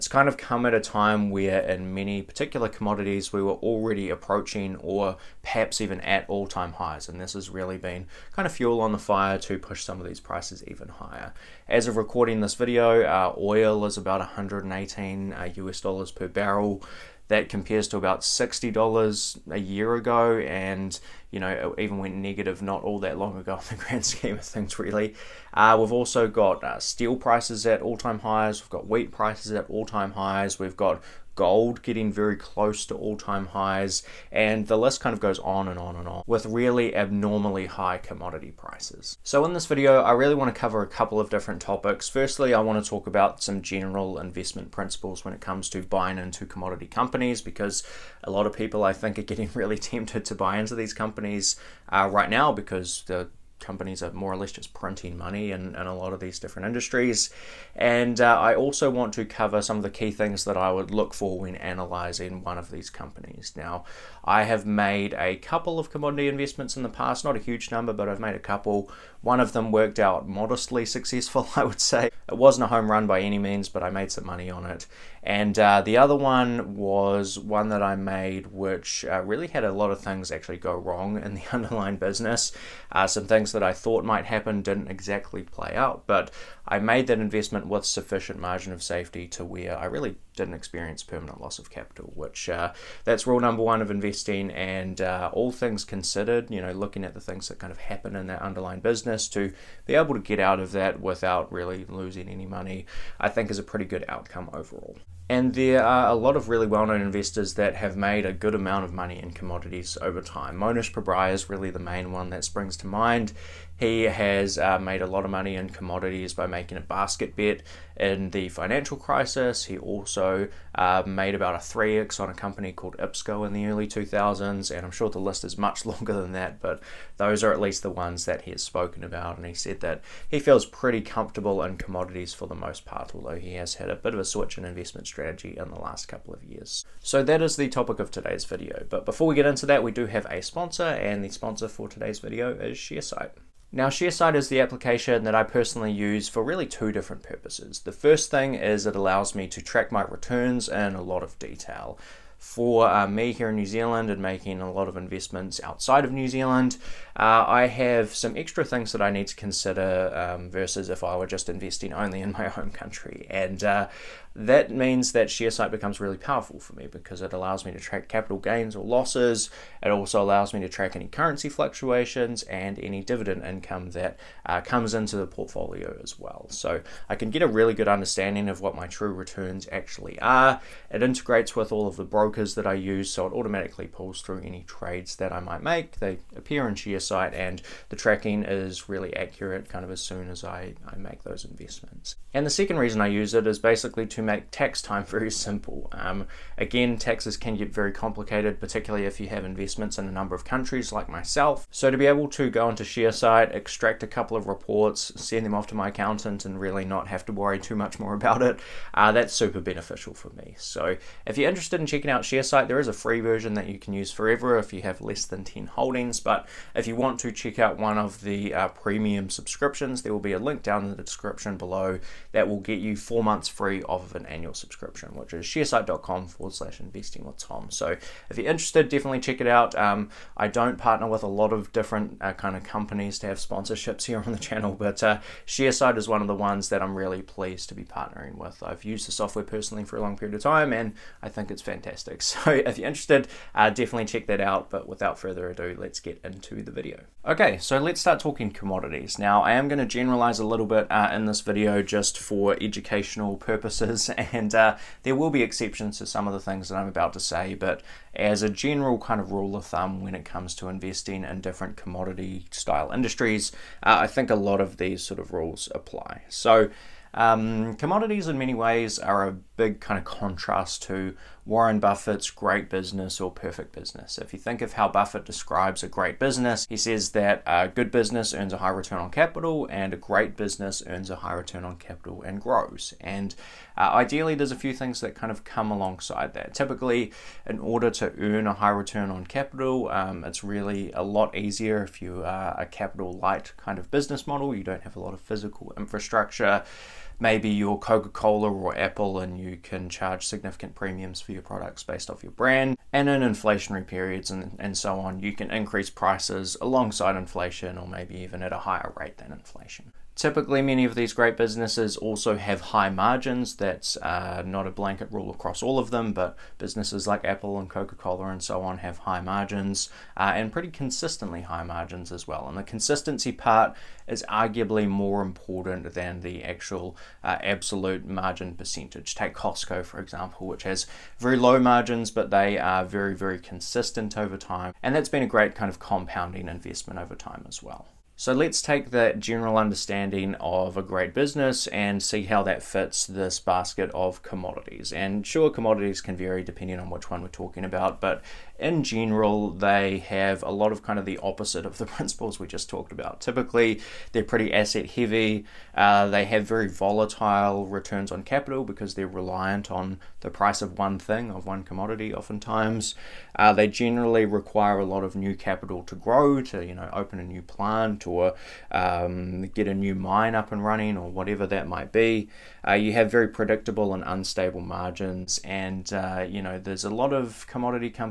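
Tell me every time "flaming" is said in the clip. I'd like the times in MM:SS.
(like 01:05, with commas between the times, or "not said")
not said.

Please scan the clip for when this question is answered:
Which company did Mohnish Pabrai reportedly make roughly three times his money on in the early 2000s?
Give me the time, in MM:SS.
02:02.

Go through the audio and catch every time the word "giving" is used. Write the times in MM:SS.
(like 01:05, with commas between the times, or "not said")
not said.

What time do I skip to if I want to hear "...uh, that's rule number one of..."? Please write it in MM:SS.
01:32.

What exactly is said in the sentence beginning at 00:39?
So, in this video, I really want to cover a couple of different topics.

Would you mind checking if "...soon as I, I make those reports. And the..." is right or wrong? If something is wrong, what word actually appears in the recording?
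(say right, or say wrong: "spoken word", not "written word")
wrong: "investments", not "reports".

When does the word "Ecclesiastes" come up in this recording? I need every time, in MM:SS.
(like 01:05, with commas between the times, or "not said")
not said.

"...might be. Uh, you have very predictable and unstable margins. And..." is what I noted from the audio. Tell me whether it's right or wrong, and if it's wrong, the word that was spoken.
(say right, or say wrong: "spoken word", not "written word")
right.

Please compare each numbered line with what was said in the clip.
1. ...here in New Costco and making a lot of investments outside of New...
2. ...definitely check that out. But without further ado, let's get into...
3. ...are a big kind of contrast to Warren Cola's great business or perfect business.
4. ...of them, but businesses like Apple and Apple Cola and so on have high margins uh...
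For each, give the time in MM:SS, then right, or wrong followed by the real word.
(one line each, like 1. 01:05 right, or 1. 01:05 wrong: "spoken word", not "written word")
1. 02:33 wrong: "Zealand", not "Costco"
2. 04:03 right
3. 04:28 wrong: "Buffett", not "Cola"
4. 05:15 wrong: "Coca", not "Apple".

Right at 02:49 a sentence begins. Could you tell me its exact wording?
It also allows me to track any currency fluctuations and any dividend income that uh, comes into the portfolio as well.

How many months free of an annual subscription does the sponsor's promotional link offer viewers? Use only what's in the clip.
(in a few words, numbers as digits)
4 months.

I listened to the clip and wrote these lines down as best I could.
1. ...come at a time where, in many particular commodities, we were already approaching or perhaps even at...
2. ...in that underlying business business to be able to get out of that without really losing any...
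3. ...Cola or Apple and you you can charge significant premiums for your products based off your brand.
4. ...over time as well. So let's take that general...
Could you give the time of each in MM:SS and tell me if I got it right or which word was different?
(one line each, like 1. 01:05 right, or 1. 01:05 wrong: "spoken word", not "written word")
1. 00:00 right
2. 01:38 right
3. 04:58 right
4. 05:36 right.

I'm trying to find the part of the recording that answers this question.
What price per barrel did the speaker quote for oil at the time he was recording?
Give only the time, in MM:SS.
00:14.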